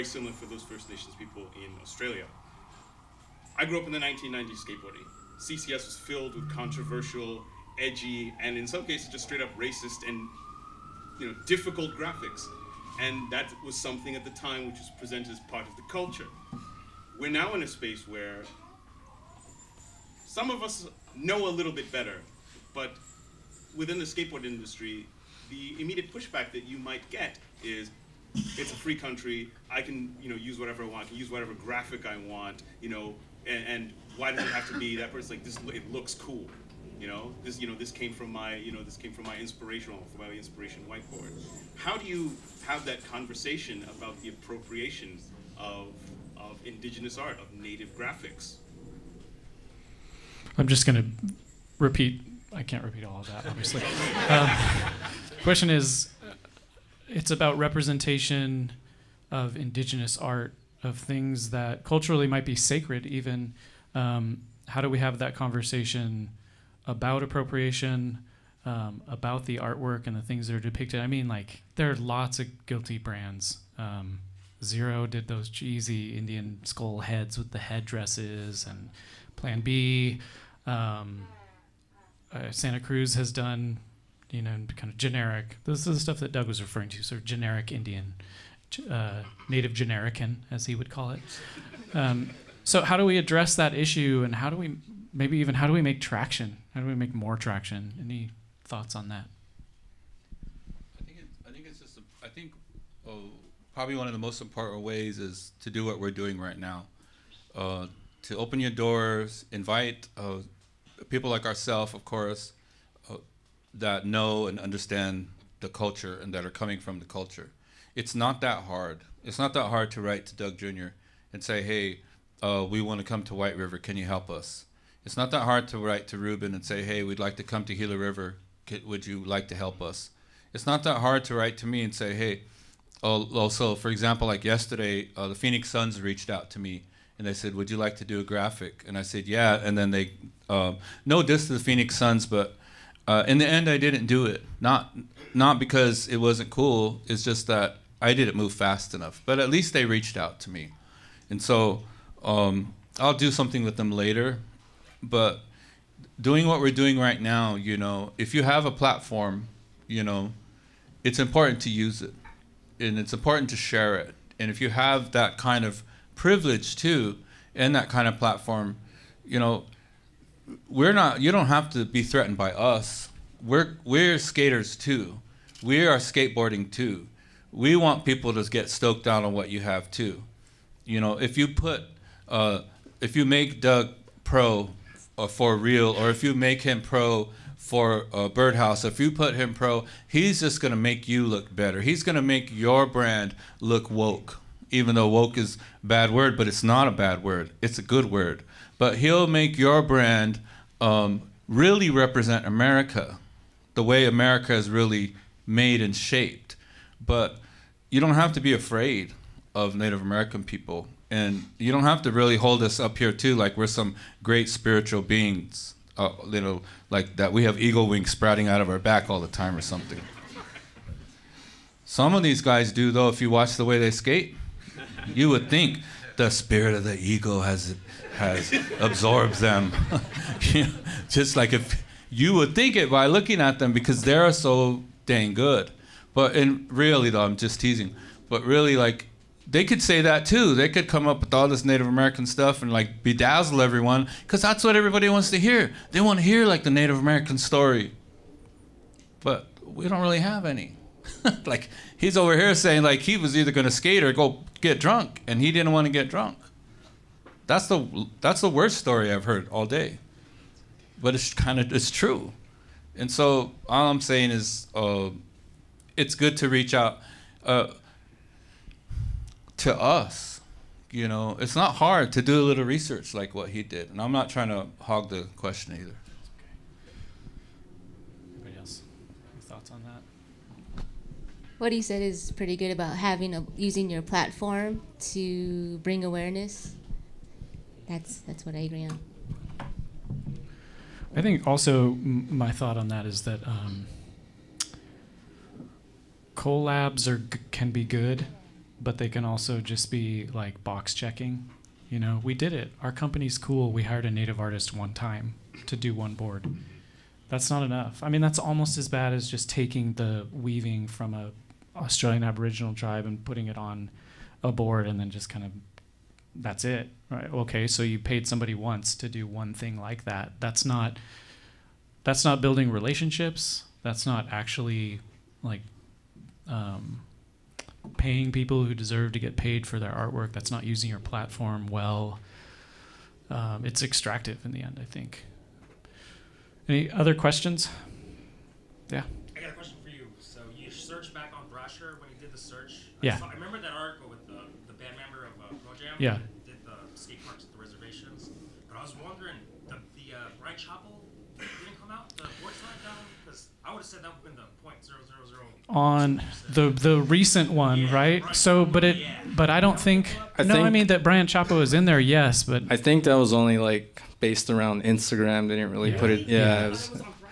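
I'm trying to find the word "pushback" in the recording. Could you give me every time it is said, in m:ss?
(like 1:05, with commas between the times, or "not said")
0:26.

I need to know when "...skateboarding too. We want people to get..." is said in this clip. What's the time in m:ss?
2:55.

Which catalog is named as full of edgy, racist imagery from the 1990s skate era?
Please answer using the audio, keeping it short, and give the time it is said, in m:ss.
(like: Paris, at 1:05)
CCS, at 0:05.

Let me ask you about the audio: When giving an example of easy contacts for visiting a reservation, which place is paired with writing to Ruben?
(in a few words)
Gila River.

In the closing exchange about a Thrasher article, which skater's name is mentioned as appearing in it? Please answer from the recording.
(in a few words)
Brian Chapa.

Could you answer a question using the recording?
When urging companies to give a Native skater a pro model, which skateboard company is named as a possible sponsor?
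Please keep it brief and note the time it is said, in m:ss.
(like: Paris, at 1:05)
Birdhouse, at 3:08.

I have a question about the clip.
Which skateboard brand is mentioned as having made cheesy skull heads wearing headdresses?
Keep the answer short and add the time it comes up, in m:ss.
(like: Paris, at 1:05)
Zero, at 1:14.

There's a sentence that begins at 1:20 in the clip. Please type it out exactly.
Um, uh, Santa Cruz has done, you know, kind of generic.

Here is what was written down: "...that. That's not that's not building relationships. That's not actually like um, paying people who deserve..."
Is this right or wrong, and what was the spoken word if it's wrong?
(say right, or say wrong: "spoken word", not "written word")
right.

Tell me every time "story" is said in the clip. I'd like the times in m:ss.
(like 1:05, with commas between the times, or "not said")
4:07, 4:18.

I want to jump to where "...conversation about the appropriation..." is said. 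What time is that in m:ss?
0:43.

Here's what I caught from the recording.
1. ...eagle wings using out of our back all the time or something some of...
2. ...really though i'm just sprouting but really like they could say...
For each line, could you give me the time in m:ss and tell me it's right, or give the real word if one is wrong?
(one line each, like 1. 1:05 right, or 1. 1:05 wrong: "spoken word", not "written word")
1. 3:37 wrong: "sprouting", not "using"
2. 3:56 wrong: "teasing", not "sprouting".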